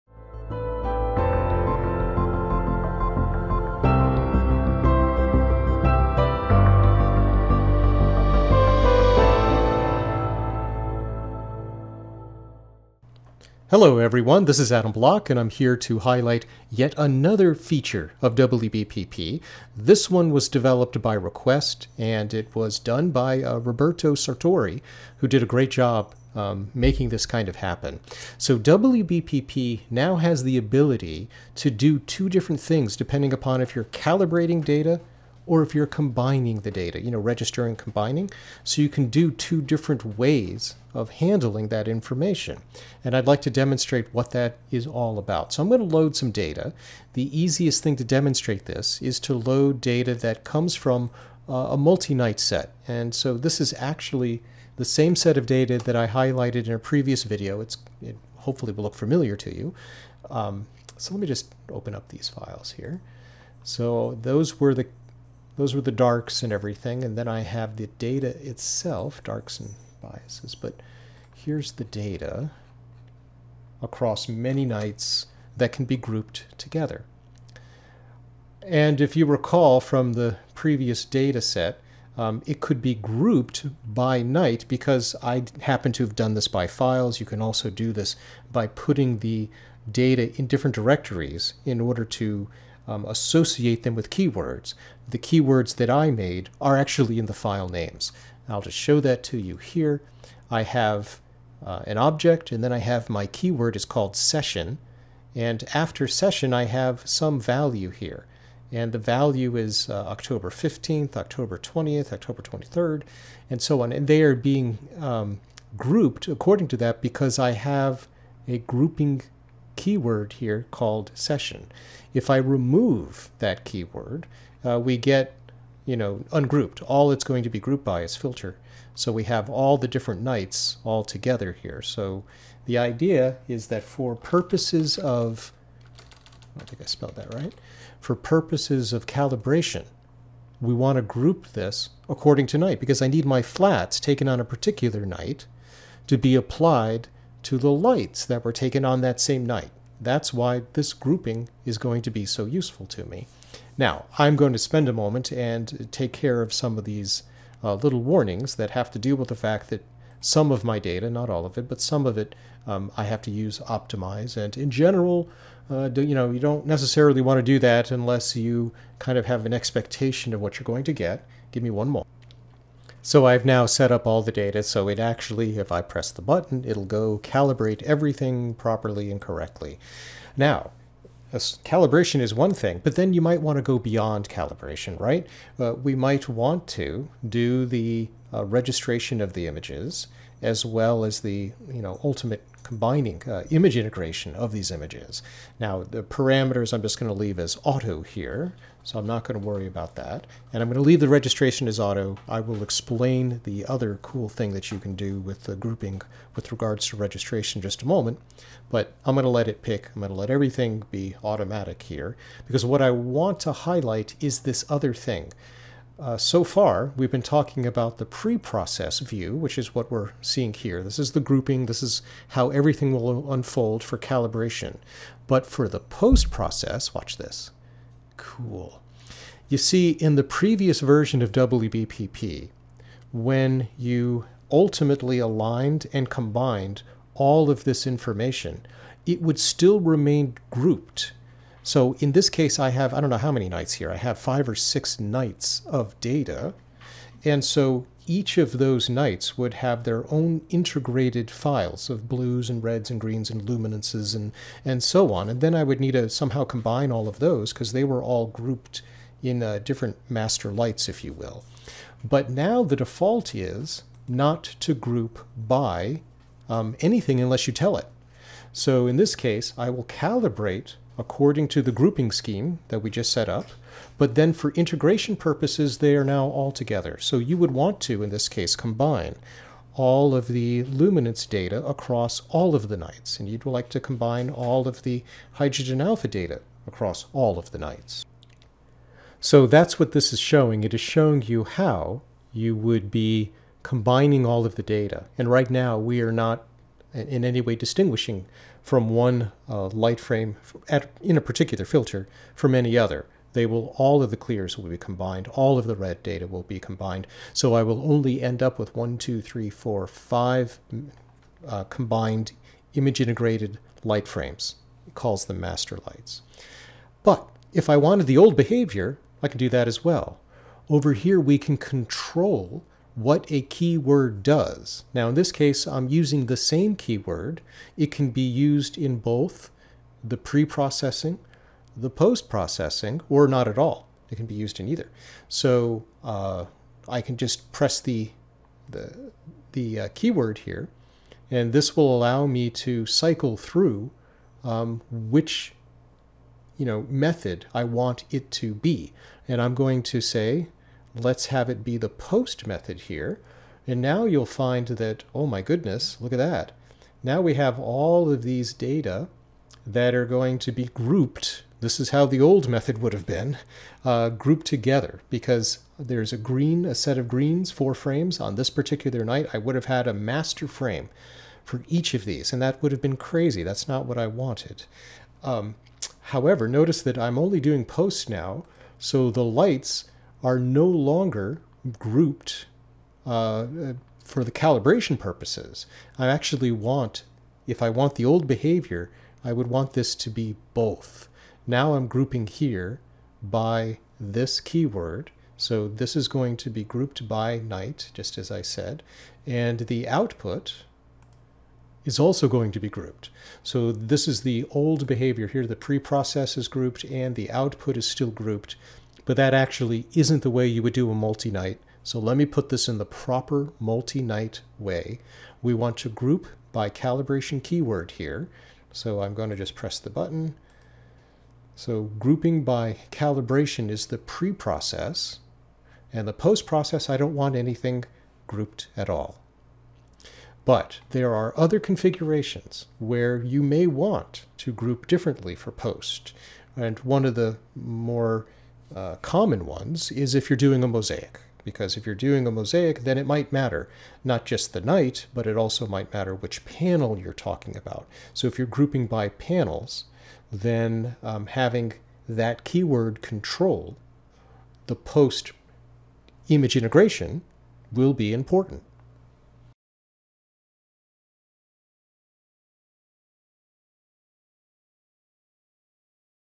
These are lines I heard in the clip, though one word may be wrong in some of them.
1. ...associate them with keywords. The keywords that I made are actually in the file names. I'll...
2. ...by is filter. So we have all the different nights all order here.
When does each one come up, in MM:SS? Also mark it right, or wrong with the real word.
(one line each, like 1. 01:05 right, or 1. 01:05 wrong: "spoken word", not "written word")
1. 01:33 right
2. 02:07 wrong: "together", not "order".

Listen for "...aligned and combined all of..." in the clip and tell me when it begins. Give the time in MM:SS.
03:55.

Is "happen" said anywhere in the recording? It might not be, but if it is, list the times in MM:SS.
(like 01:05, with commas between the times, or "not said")
00:27, 01:25.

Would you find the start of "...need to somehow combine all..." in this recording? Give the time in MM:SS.
04:15.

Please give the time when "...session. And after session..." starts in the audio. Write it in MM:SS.
01:44.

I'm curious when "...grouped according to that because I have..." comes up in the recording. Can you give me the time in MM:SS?
01:55.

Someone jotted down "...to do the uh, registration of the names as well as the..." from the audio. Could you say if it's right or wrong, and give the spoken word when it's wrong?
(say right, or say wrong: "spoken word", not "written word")
wrong: "images", not "names".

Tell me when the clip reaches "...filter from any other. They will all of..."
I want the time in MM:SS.
05:01.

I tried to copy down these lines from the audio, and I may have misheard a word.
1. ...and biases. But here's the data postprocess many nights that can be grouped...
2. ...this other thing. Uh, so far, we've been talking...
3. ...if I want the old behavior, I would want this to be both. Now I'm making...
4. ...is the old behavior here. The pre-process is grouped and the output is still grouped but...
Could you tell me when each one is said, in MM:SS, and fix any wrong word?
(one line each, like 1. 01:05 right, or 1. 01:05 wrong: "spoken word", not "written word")
1. 01:09 wrong: "across", not "postprocess"
2. 03:34 right
3. 06:27 wrong: "grouping", not "making"
4. 06:44 right.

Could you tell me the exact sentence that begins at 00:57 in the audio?
It's, it hopefully will look familiar to you.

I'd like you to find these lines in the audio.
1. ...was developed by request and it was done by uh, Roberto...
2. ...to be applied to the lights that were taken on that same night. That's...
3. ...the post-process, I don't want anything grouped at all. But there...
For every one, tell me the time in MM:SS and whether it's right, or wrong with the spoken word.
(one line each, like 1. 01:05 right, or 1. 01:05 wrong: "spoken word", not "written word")
1. 00:20 right
2. 02:26 right
3. 07:06 right.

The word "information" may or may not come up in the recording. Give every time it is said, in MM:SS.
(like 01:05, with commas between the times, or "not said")
00:41, 03:57.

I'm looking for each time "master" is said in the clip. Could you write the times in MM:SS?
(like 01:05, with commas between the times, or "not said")
04:20, 05:15, 06:09.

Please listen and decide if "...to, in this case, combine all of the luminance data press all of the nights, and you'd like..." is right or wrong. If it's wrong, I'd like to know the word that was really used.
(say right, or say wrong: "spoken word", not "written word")
wrong: "across", not "press".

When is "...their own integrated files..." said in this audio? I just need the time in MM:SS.
04:09.